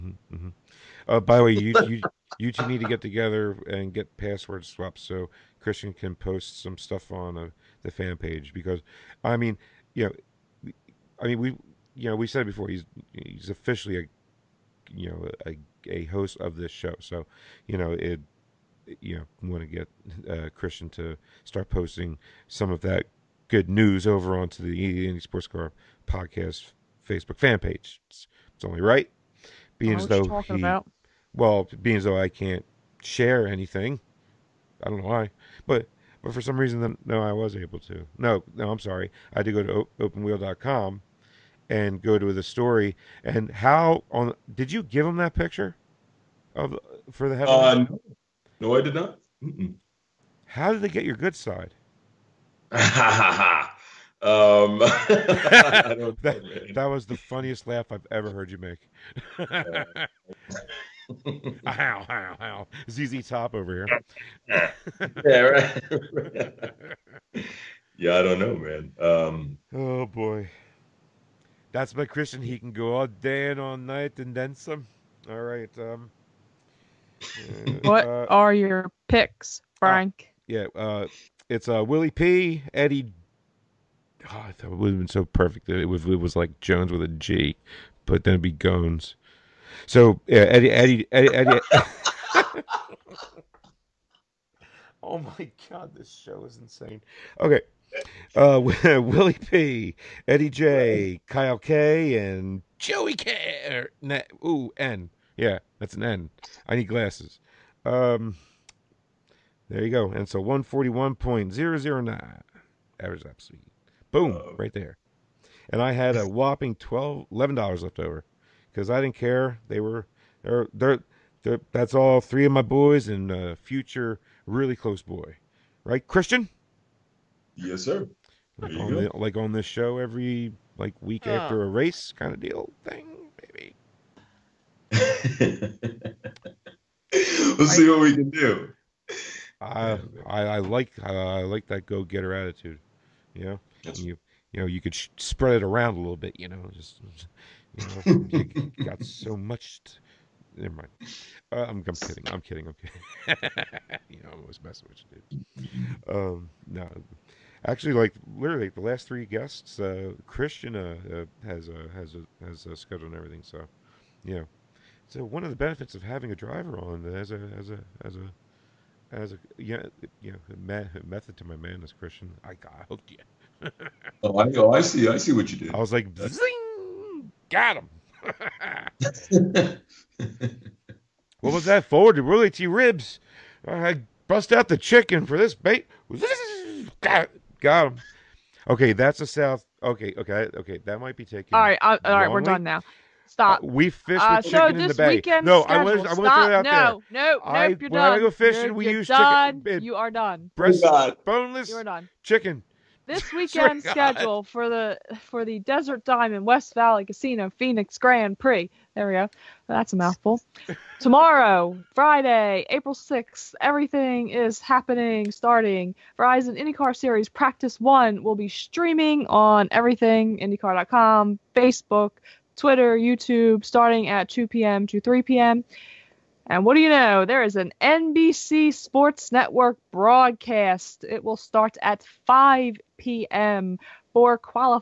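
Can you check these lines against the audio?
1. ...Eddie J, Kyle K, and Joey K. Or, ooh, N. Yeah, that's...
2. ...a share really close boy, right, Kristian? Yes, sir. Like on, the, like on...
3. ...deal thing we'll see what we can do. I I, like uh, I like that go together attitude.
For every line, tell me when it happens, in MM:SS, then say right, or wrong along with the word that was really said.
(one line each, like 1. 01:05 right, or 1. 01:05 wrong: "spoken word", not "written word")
1. 01:40 right
2. 02:03 wrong: "future", not "share"
3. 02:12 wrong: "getter", not "together".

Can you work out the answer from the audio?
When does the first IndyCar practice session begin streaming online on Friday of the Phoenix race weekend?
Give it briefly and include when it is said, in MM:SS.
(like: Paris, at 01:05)
2 p.m., at 03:44.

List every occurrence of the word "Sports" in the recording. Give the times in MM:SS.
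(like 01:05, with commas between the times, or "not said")
00:25, 03:48.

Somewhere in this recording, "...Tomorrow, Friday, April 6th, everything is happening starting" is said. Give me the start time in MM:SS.
03:30.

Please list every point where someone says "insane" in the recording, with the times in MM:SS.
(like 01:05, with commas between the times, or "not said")
01:36.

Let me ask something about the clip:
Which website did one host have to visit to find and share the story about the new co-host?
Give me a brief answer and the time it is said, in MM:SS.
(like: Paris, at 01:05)
openwheel.com, at 00:39.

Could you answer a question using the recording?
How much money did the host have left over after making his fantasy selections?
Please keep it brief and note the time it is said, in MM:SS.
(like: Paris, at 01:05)
12 dollars, at 01:56.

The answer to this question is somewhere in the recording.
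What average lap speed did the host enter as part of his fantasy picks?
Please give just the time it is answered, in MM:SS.
01:50.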